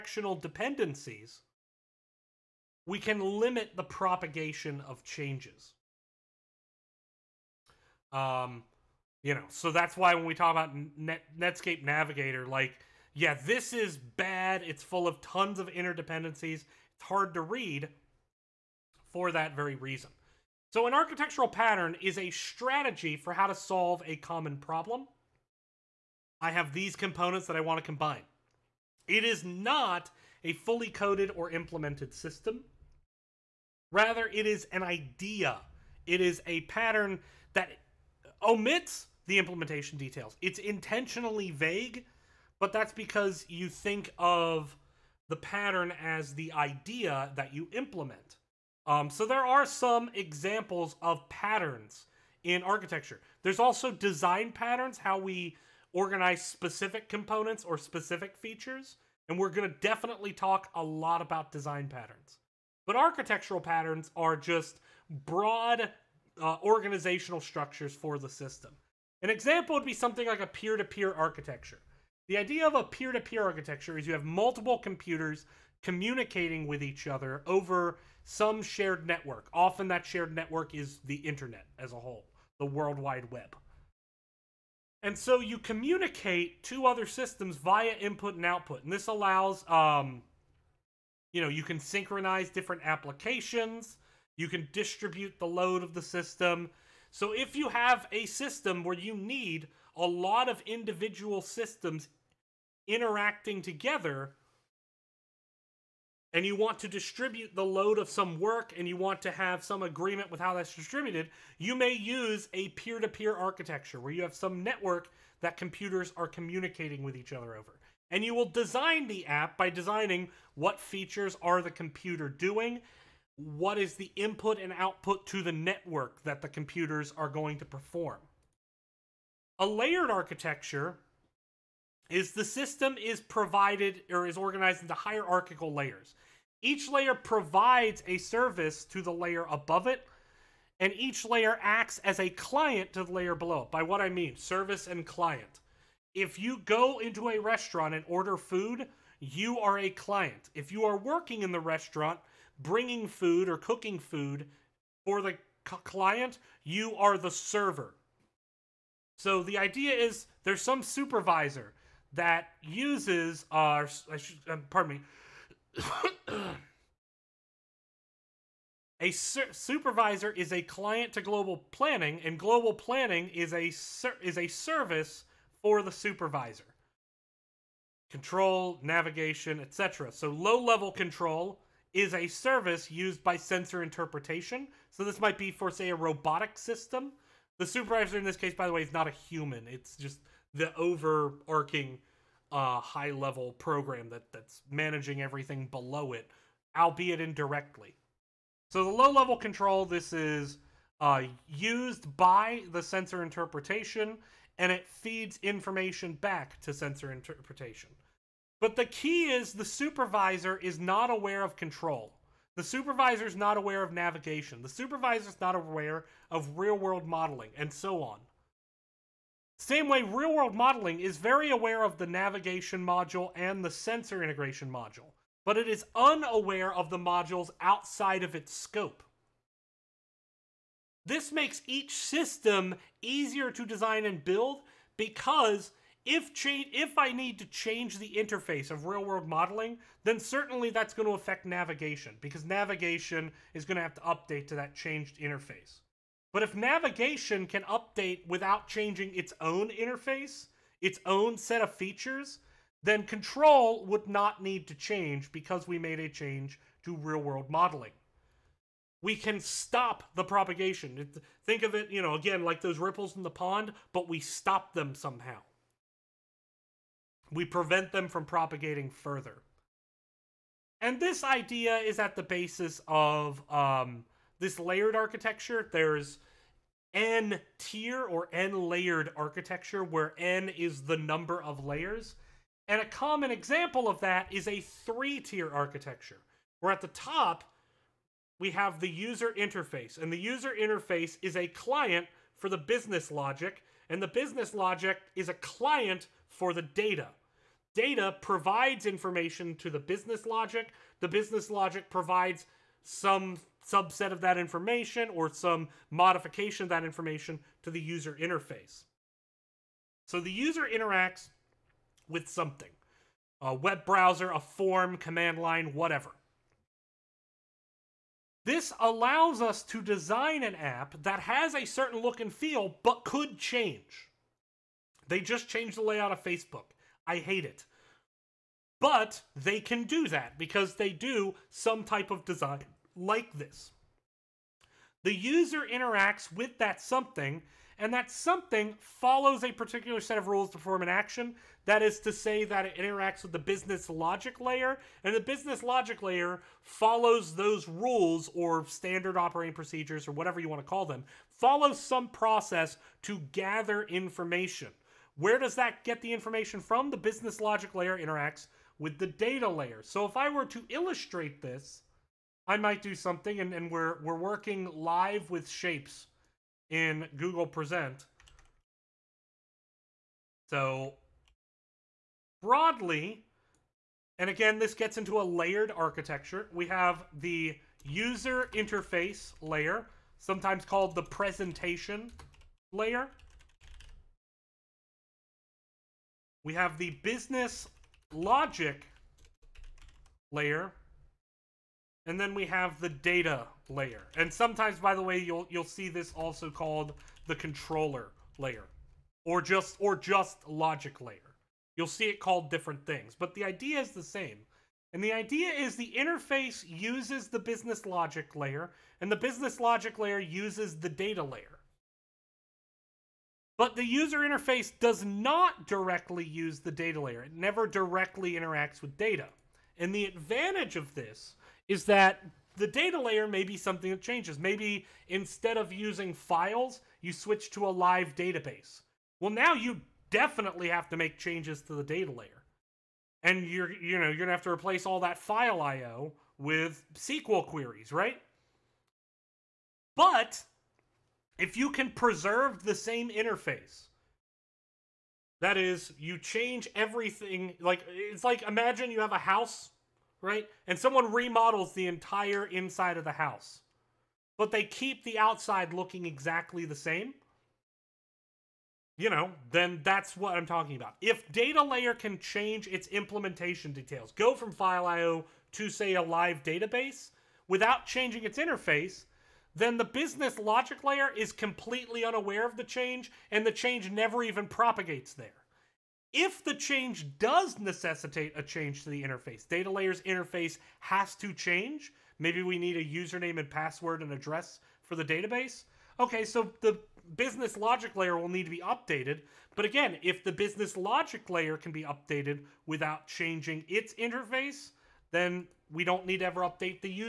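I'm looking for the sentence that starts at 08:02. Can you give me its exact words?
Maybe we need a username and password and address for the database.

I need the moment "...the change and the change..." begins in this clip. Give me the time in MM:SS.
07:52.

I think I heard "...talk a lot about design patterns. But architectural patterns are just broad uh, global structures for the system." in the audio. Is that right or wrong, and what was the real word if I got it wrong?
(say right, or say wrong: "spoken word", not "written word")
wrong: "organizational", not "global".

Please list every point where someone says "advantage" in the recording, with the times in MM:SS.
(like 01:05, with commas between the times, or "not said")
07:00.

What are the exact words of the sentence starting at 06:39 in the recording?
Or just or just logic layer.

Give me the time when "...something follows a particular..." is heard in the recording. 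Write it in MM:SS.
05:38.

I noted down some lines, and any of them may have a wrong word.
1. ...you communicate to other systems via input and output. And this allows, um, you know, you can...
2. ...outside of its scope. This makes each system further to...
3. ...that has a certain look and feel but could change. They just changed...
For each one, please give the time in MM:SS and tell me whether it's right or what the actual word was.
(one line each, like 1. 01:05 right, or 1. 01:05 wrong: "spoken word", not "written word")
1. 01:25 right
2. 03:47 wrong: "easier", not "further"
3. 05:21 right.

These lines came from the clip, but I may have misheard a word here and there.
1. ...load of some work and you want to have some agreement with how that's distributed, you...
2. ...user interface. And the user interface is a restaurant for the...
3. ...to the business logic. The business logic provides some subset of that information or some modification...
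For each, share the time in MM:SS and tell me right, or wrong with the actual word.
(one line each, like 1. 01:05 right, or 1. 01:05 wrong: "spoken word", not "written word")
1. 01:47 right
2. 04:48 wrong: "client", not "restaurant"
3. 04:59 right.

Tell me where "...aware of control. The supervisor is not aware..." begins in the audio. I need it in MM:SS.
03:31.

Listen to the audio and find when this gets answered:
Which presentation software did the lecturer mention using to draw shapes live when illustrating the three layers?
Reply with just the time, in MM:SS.
06:07.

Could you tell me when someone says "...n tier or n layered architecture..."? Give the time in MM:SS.
04:36.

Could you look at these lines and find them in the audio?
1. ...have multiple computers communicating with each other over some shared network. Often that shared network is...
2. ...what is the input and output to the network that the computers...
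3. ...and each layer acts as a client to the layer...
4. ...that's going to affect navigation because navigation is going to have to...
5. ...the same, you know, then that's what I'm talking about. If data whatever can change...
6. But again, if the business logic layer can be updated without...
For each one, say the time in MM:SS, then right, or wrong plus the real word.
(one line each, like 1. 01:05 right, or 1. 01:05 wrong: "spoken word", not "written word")
1. 01:14 right
2. 02:03 right
3. 02:20 right
4. 04:00 right
5. 07:36 wrong: "layer", not "whatever"
6. 08:09 right.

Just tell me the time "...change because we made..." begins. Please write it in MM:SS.
04:14.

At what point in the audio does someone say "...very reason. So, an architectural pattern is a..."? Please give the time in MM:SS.
00:19.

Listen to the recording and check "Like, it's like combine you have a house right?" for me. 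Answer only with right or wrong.
wrong.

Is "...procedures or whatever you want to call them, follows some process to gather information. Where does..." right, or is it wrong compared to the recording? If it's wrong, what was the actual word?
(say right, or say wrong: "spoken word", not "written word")
right.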